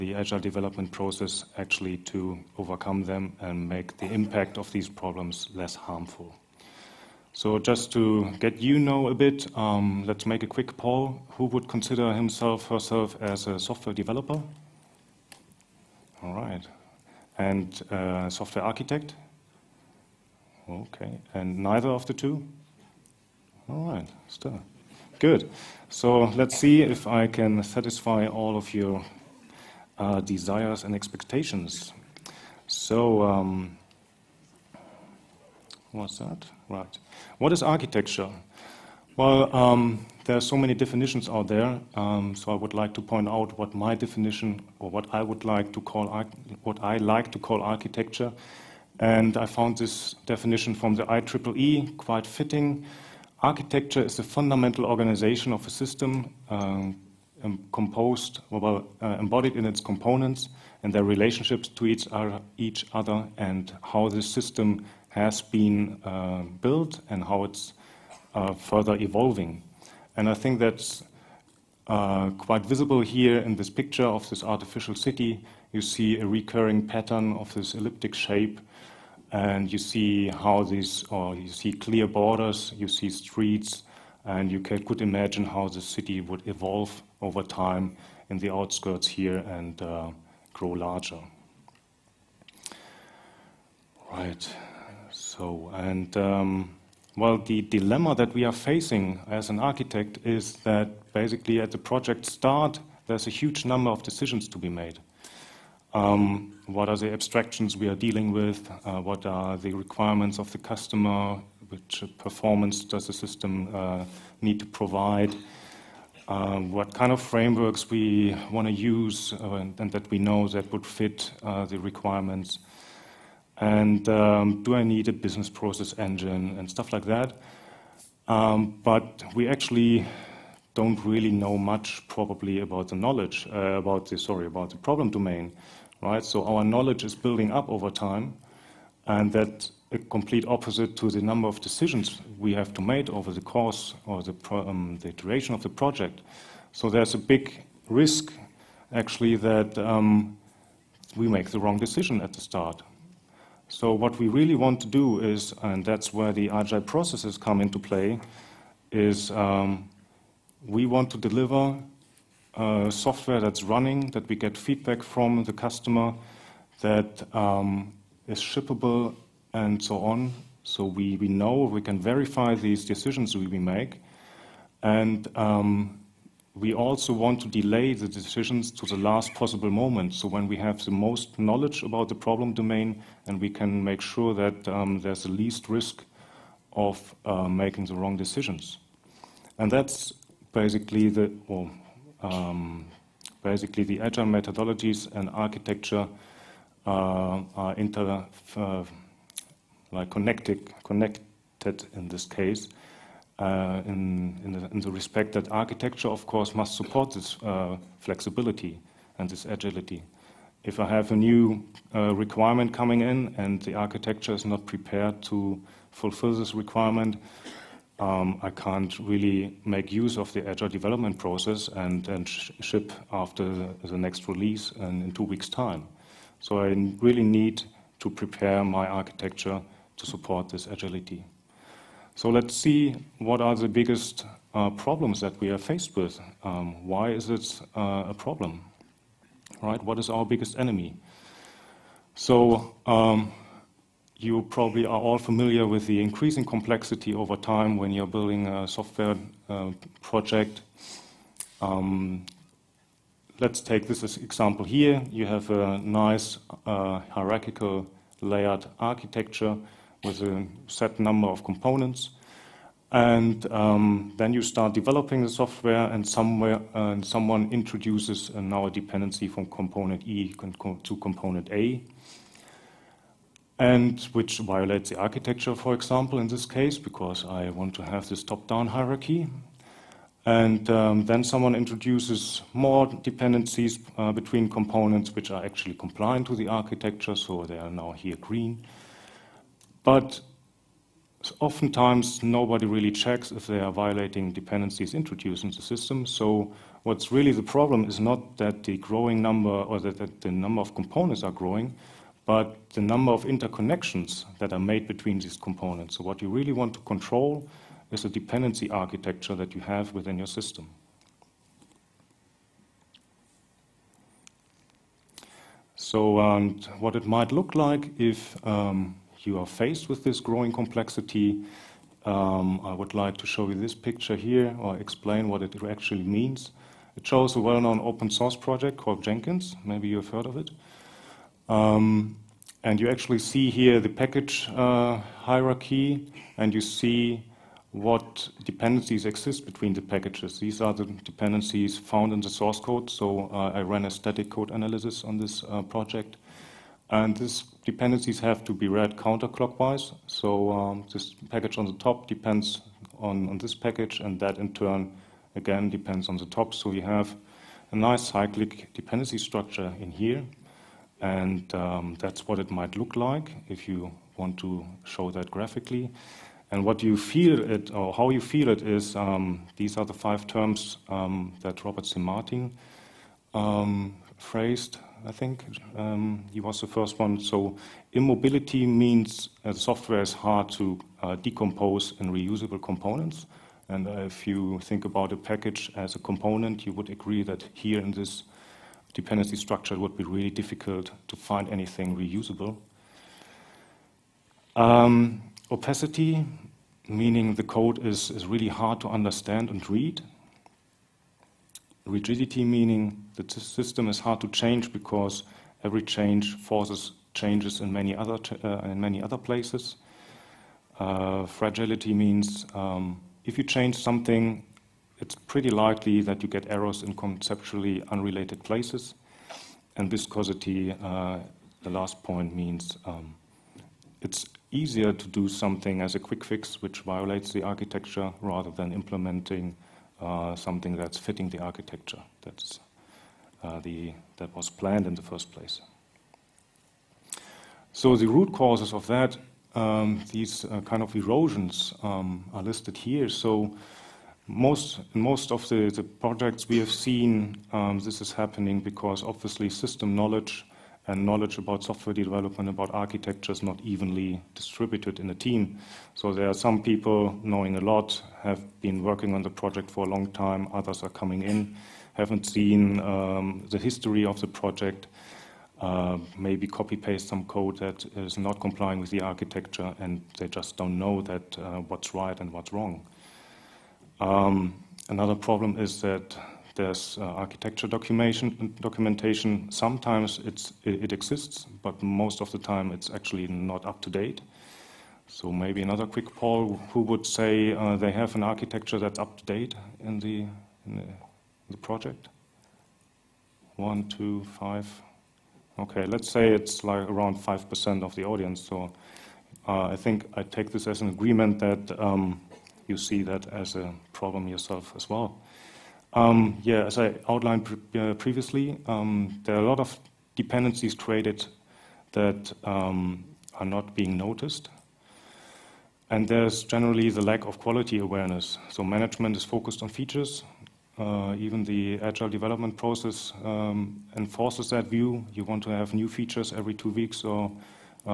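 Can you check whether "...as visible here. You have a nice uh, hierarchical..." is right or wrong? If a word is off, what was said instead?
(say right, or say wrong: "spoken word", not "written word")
wrong: "example", not "visible".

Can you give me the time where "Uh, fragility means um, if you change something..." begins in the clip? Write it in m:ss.
6:50.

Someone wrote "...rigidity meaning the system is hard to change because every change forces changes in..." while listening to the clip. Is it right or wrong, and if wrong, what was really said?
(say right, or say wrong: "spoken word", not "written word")
right.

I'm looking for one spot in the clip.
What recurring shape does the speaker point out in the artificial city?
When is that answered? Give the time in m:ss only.
1:17.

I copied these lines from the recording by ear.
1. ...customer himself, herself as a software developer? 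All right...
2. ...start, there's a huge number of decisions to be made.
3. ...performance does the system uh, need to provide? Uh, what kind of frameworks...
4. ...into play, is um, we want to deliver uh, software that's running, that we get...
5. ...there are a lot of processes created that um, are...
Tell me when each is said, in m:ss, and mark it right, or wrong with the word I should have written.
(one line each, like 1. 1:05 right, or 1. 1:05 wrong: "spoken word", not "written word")
1. 0:11 wrong: "consider", not "customer"
2. 1:42 right
3. 1:52 right
4. 2:37 right
5. 8:29 wrong: "dependencies", not "processes".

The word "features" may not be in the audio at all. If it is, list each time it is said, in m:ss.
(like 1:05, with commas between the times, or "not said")
8:39, 8:45.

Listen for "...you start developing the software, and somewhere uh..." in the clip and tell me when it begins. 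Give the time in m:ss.
4:24.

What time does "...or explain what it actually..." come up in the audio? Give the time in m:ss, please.
5:24.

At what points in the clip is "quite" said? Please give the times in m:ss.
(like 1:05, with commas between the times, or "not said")
0:51, 1:12.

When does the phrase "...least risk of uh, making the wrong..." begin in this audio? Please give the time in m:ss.
3:05.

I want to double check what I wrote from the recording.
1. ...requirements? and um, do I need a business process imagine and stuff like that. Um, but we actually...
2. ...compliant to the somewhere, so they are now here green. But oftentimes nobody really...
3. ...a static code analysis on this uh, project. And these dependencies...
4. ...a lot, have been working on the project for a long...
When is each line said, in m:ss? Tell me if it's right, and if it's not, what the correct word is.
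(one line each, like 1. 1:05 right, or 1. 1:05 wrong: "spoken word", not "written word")
1. 2:01 wrong: "engine", not "imagine"
2. 4:45 wrong: "architecture", not "somewhere"
3. 5:43 right
4. 7:37 right.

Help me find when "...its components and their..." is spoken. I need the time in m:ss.
0:59.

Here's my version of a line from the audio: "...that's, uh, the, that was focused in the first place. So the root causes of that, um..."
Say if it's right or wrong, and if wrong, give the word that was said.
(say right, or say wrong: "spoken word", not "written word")
wrong: "planned", not "focused".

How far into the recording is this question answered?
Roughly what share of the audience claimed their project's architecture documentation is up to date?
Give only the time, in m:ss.
8:17.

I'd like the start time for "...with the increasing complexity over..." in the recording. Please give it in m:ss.
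4:05.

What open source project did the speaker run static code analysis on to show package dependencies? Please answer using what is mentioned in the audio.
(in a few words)
Jenkins.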